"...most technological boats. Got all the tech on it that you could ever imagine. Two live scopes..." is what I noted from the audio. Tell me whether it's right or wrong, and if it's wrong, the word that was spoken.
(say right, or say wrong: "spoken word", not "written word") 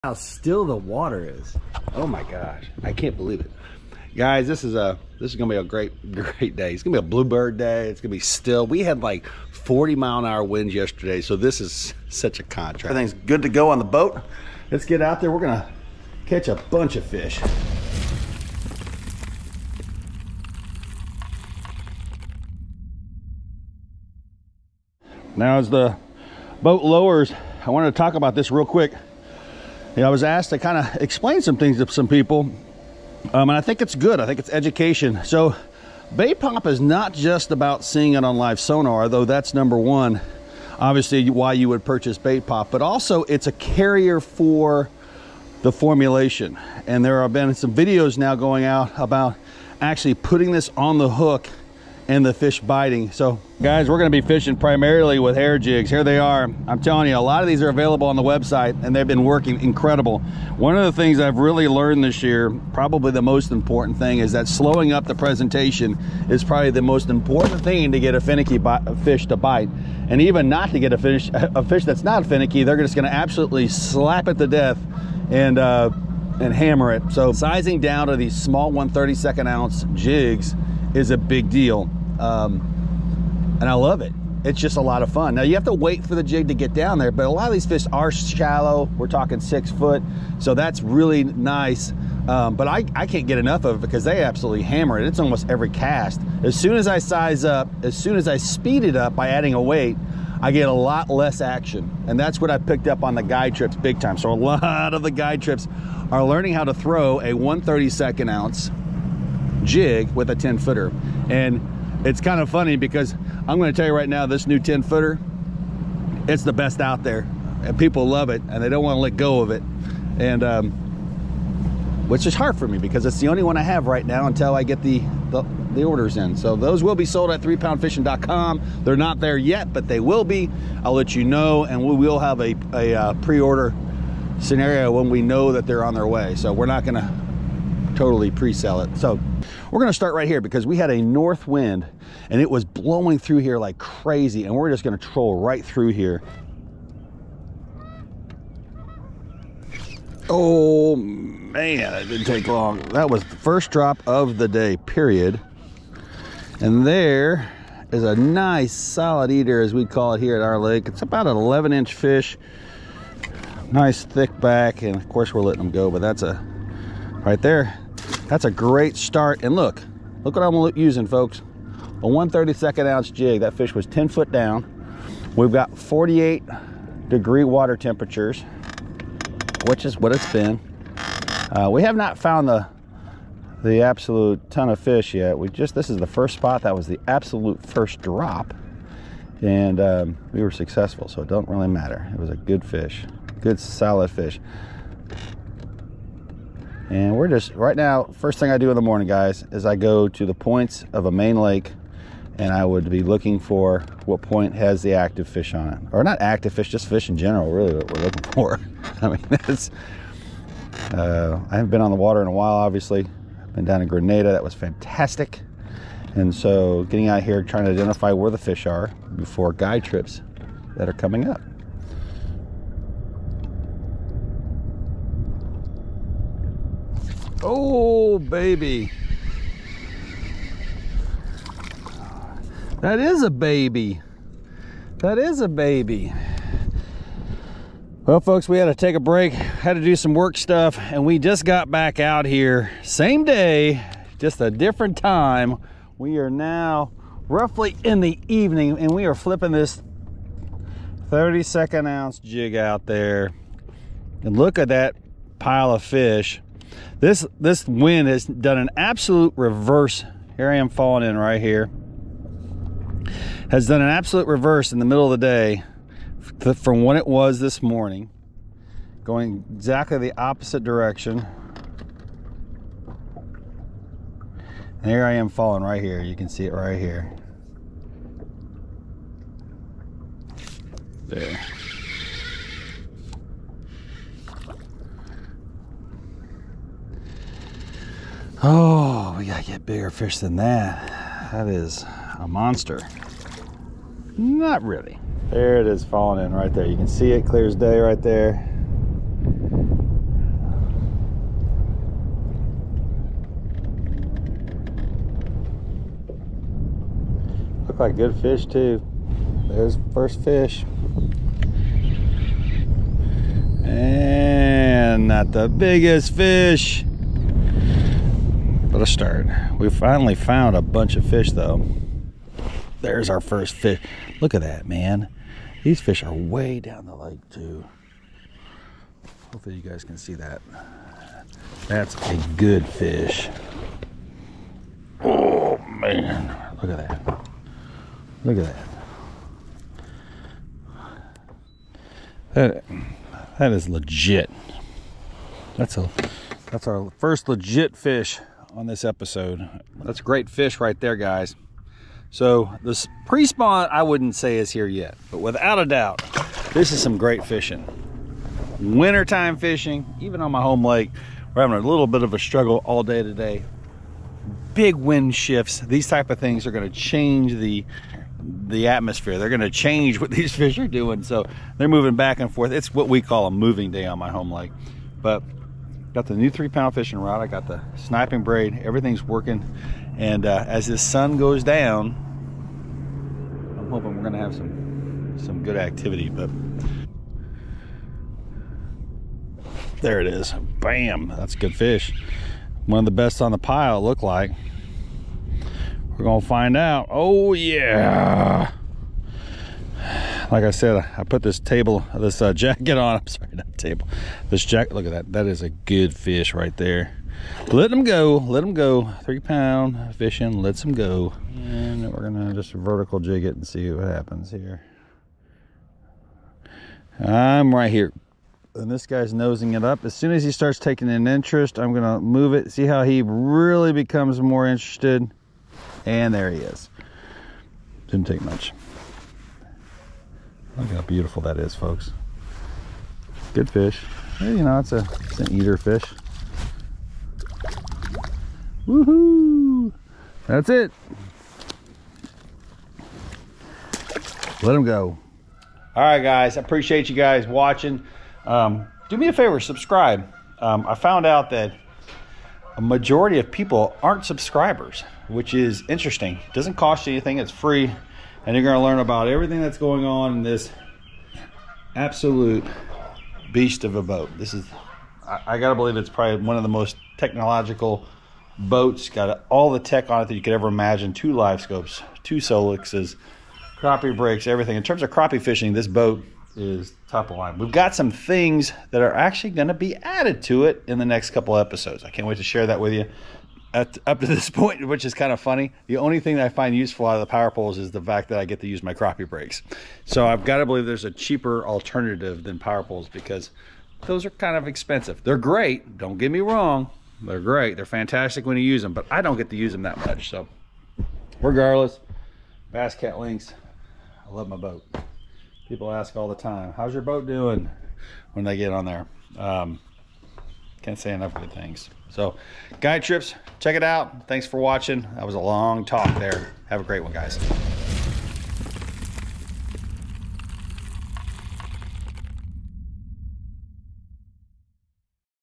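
right.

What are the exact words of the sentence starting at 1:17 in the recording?
So sizing down to these small 132nd ounce jigs is a big deal.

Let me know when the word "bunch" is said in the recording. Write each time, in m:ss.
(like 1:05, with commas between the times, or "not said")
0:16, 5:20.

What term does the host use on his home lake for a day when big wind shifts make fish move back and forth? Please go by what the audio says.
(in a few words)
Moving day.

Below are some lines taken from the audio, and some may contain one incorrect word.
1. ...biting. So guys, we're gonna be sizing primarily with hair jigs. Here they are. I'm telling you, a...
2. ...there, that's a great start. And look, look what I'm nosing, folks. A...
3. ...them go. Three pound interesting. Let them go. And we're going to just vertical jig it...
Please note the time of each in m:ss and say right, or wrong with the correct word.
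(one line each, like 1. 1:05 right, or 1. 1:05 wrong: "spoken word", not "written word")
1. 0:52 wrong: "fishing", not "sizing"
2. 2:47 wrong: "using", not "nosing"
3. 6:48 wrong: "fishing", not "interesting".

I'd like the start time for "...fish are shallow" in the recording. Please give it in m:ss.
1:27.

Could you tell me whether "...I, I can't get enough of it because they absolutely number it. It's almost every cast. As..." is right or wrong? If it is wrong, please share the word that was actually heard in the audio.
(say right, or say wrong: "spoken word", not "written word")
wrong: "hammer", not "number".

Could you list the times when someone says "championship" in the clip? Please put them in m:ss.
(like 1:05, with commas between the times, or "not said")
not said.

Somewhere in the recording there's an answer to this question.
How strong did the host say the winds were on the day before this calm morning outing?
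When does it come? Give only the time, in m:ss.
0:09.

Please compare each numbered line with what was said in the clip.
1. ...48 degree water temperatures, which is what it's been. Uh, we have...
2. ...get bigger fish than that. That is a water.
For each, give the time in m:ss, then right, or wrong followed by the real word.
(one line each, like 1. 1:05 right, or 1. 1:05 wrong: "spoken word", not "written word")
1. 2:55 right
2. 4:49 wrong: "monster", not "water".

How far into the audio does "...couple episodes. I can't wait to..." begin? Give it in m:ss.
8:01.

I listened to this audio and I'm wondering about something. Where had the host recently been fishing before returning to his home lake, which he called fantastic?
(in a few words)
Grenada.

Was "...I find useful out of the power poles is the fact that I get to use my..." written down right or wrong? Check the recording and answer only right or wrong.
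right.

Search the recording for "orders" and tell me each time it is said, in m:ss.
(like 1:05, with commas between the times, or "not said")
2:05, 2:13.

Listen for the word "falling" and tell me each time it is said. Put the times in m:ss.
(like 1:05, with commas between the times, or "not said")
4:20, 4:35, 4:55.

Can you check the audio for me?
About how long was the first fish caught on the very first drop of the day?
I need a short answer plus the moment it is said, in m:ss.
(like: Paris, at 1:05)
11 inches, at 2:41.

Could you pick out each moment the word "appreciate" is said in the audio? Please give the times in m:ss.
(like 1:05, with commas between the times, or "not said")
7:26.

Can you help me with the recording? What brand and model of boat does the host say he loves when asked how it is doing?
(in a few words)
Bass Cat Lynx.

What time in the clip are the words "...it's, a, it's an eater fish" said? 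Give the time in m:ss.
7:14.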